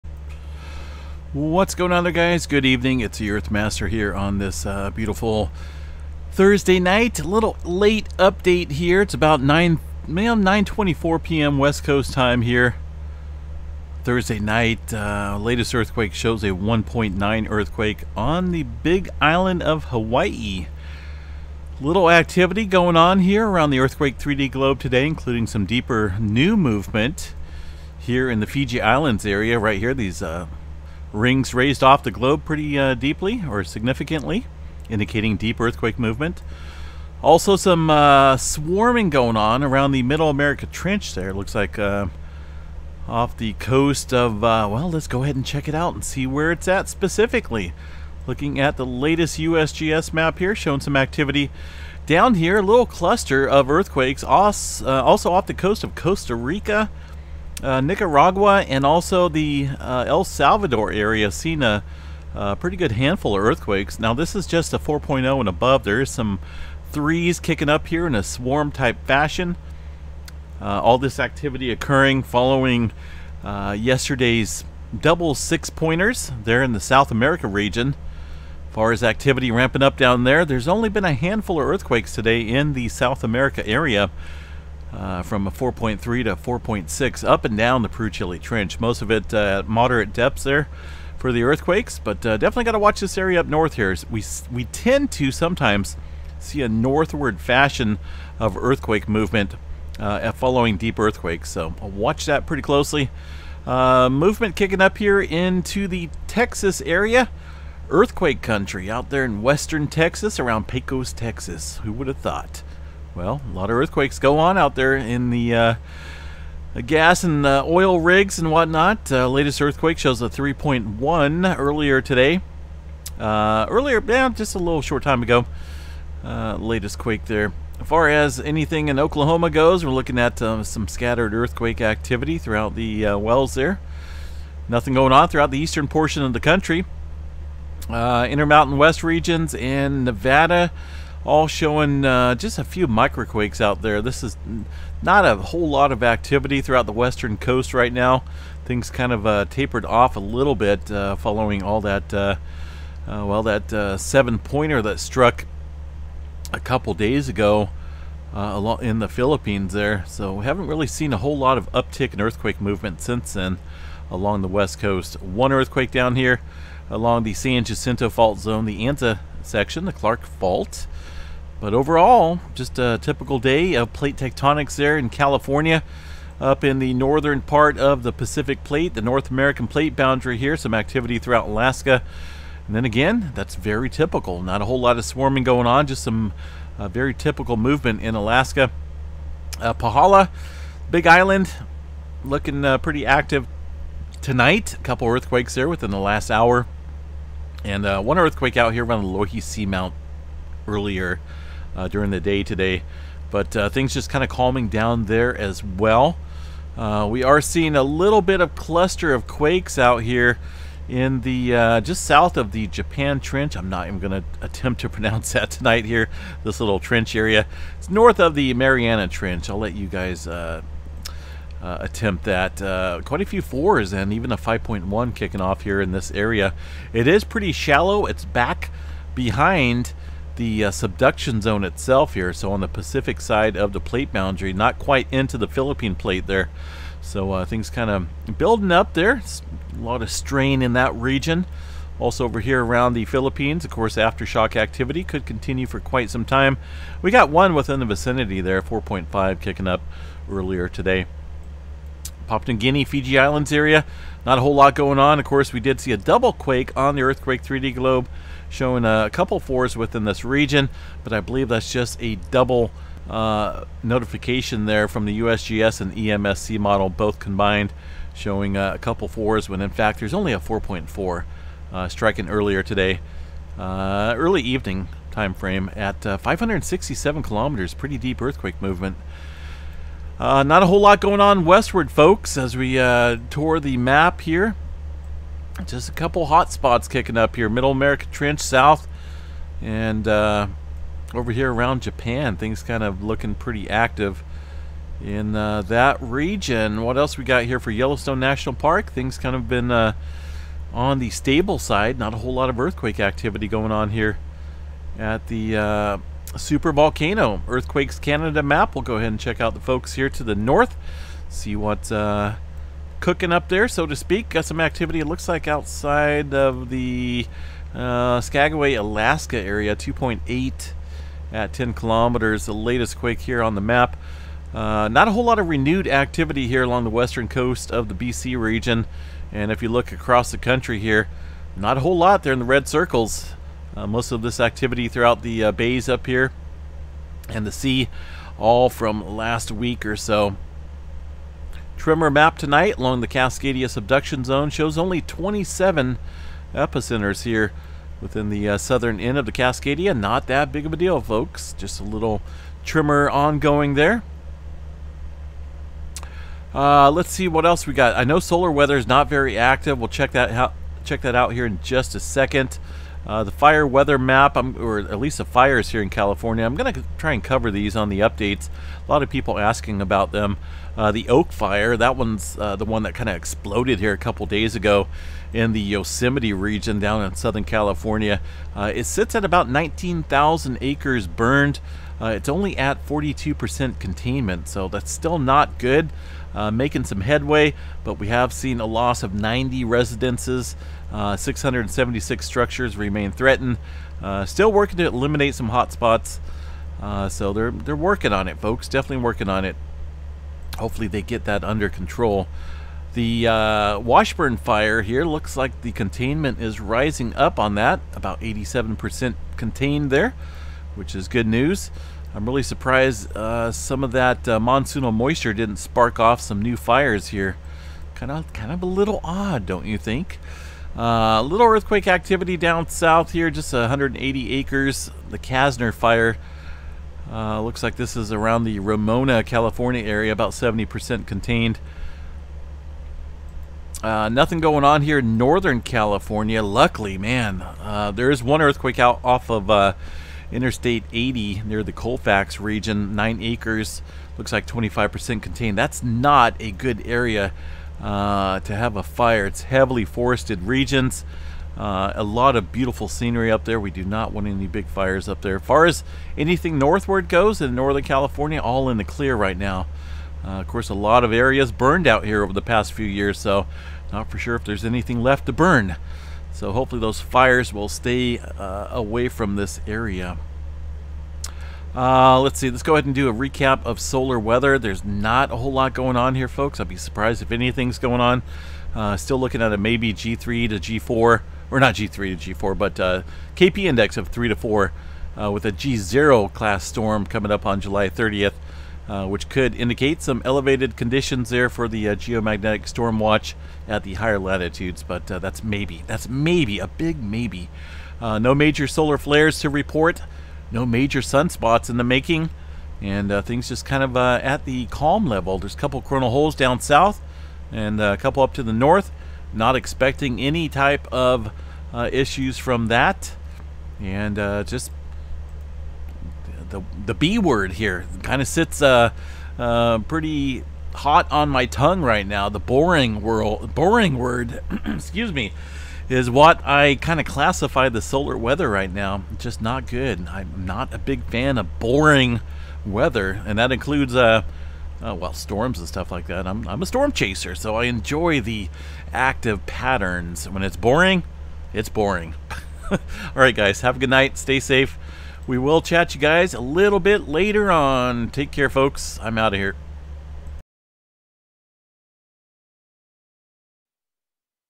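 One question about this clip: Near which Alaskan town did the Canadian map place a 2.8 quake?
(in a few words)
Skagway.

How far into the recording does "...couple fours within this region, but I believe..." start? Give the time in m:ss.
4:19.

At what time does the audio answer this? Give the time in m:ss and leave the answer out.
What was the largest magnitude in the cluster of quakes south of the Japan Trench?
3:44.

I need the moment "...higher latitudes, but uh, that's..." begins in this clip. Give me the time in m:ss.
8:13.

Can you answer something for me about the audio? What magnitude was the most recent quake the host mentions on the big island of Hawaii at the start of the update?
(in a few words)
1.9.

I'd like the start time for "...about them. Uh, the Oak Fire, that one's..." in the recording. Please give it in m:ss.
6:09.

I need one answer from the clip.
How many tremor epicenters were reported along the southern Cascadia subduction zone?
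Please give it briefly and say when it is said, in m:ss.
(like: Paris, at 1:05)
27, at 5:45.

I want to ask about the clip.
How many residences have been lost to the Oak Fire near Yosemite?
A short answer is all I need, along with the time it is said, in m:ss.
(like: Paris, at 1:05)
90, at 6:29.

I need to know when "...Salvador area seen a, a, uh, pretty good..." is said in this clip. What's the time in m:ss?
1:00.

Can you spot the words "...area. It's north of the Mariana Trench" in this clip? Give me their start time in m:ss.
3:37.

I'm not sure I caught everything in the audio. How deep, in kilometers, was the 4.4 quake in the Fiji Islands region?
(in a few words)
567.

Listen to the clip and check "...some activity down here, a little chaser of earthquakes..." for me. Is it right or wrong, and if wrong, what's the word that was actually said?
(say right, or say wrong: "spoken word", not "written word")
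wrong: "cluster", not "chaser".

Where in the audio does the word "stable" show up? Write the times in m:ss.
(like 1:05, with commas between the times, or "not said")
5:01.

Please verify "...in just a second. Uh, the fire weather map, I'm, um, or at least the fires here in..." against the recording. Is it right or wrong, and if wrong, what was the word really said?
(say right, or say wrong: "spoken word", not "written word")
right.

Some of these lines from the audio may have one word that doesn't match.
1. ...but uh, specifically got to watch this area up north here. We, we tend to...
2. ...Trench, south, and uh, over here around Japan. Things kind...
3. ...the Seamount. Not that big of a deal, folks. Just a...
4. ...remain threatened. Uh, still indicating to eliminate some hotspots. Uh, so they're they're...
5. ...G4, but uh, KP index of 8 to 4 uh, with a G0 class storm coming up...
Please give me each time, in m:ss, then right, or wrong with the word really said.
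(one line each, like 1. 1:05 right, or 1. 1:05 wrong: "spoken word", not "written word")
1. 1:31 wrong: "definitely", not "specifically"
2. 4:48 right
3. 5:49 wrong: "Cascadia", not "Seamount"
4. 6:32 wrong: "working", not "indicating"
5. 8:02 wrong: "3", not "8".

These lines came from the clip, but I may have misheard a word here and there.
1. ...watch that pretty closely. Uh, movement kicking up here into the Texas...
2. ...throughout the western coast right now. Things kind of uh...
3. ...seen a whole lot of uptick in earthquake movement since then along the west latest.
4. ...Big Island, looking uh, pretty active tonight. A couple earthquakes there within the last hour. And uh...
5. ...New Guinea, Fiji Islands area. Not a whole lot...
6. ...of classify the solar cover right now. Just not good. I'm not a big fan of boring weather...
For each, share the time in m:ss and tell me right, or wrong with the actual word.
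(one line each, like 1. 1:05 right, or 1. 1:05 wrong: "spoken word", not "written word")
1. 1:41 right
2. 2:26 right
3. 2:40 wrong: "coast", not "latest"
4. 3:10 right
5. 4:12 right
6. 8:46 wrong: "weather", not "cover".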